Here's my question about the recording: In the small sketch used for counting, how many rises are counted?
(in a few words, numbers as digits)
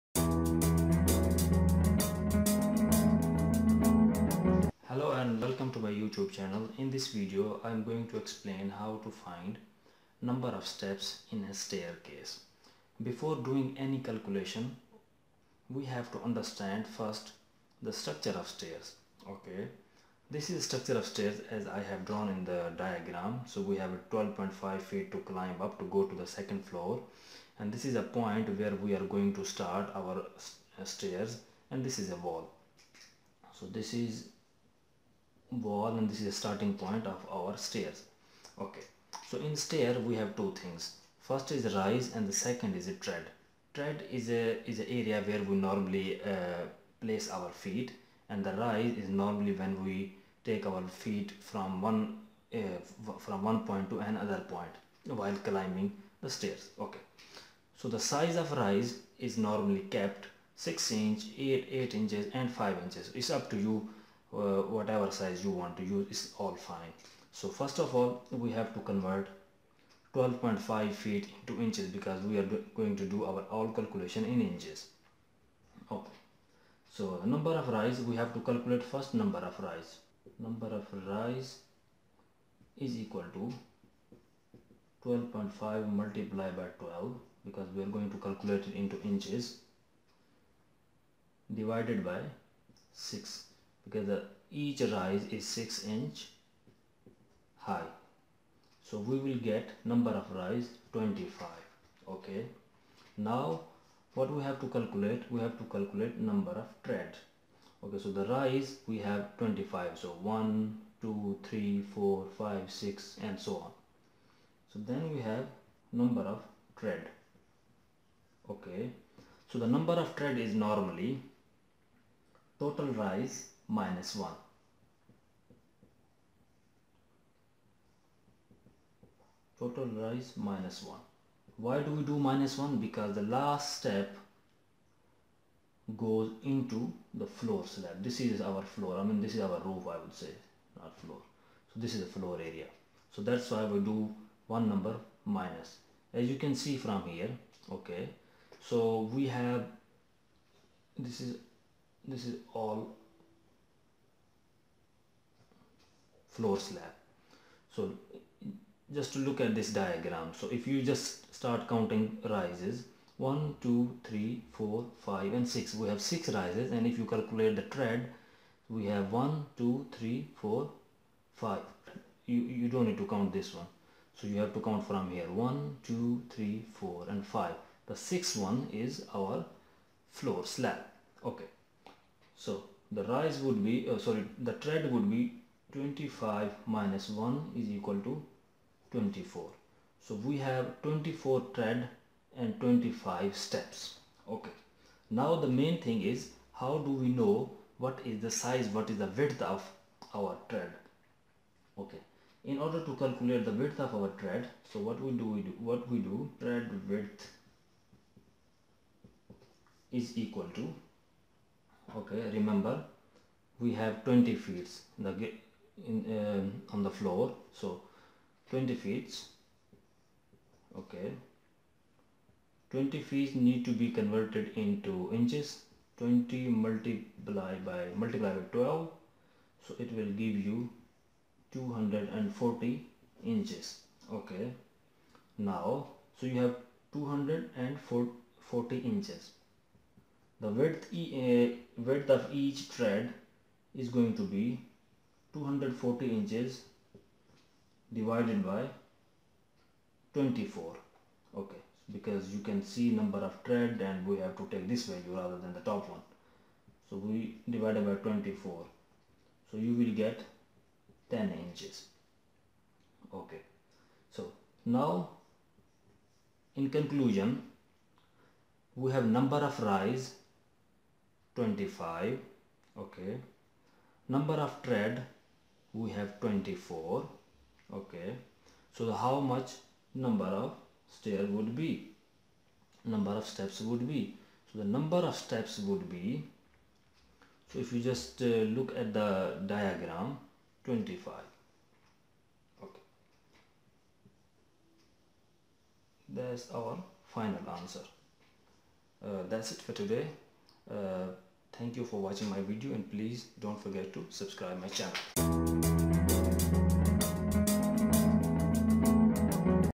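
6.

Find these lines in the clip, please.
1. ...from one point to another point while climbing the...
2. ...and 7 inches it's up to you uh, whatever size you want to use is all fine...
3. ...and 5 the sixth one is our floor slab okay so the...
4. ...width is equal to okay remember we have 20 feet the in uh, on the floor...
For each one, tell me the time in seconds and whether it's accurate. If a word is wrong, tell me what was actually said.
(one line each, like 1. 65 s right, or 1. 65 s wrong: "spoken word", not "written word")
1. 53 s right
2. 62 s wrong: "5", not "7"
3. 177 s right
4. 206 s right.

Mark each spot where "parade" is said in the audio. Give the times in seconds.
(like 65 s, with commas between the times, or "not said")
not said.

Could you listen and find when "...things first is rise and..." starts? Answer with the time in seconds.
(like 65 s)
40 s.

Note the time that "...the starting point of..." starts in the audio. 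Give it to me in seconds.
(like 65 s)
36 s.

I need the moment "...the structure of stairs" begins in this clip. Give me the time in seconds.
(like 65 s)
17 s.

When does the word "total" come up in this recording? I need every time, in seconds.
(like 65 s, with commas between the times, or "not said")
122 s, 129 s.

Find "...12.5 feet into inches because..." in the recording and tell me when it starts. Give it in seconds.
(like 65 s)
70 s.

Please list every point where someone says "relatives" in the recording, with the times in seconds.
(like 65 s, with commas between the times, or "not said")
not said.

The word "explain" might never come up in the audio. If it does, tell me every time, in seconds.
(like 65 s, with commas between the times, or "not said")
8 s.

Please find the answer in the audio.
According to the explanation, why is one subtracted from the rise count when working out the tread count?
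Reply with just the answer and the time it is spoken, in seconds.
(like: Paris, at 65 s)
The last step goes into the floor slab, at 133 s.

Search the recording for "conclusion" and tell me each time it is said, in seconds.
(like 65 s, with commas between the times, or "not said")
266 s.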